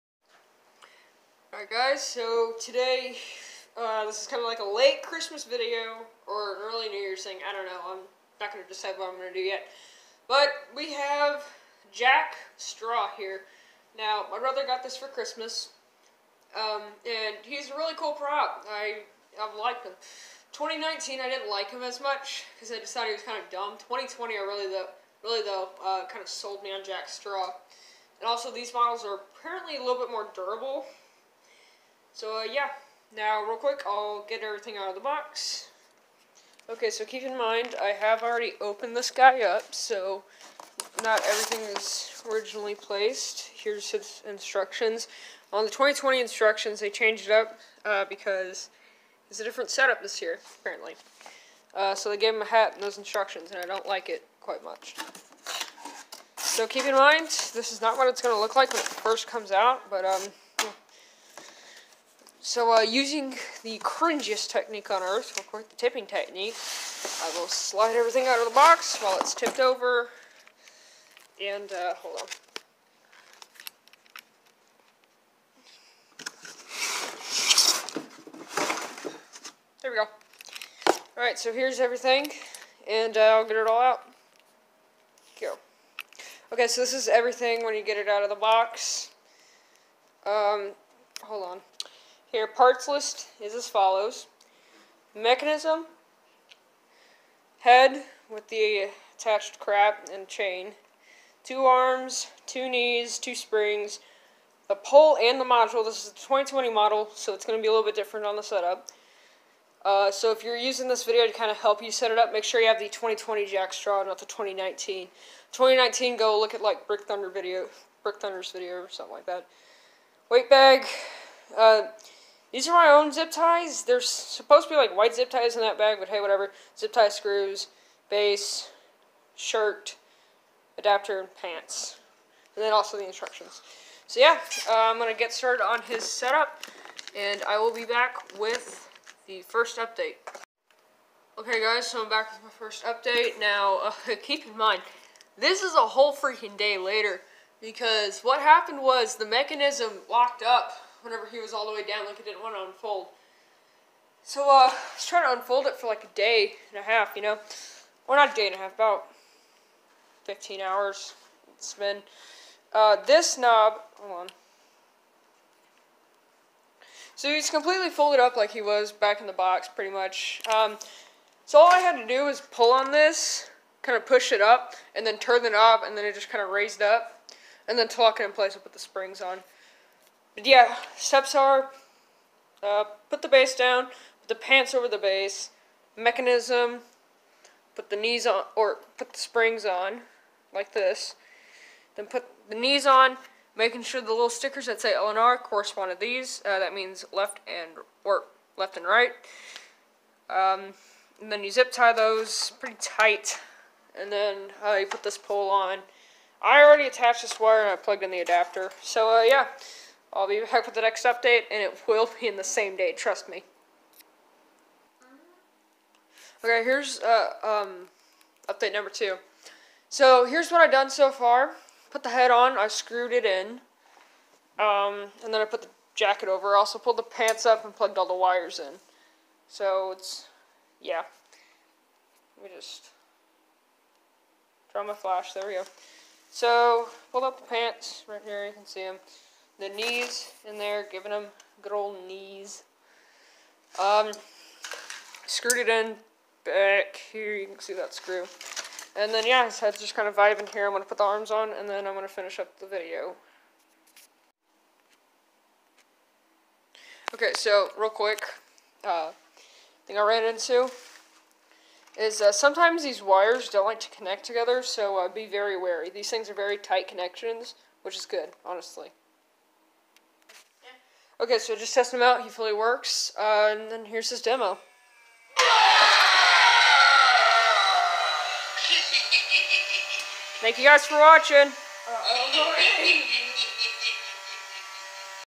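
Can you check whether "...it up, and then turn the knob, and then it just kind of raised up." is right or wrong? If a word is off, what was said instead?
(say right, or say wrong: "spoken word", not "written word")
right.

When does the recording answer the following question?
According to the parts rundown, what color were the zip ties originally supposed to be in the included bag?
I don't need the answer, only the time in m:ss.
2:04.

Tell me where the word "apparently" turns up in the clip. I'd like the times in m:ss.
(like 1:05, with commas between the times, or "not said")
0:29, 0:50.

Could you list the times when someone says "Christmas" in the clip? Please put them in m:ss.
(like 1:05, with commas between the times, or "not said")
0:05, 0:15.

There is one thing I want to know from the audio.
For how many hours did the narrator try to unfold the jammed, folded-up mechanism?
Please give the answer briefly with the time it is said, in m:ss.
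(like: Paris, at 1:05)
15, at 2:40.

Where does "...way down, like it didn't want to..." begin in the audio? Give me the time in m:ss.
2:31.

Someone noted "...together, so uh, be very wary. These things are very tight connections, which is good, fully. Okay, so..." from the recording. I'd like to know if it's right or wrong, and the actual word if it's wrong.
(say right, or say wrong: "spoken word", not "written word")
wrong: "honestly", not "fully".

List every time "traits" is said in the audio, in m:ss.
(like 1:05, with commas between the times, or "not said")
not said.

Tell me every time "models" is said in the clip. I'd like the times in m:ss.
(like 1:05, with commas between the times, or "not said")
0:28, 1:46.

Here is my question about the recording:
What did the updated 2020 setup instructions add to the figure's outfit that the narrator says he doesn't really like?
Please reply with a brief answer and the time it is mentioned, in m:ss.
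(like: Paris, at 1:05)
A hat, at 0:52.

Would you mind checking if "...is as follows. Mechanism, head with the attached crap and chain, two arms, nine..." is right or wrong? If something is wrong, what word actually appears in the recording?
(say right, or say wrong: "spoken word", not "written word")
wrong: "two", not "nine".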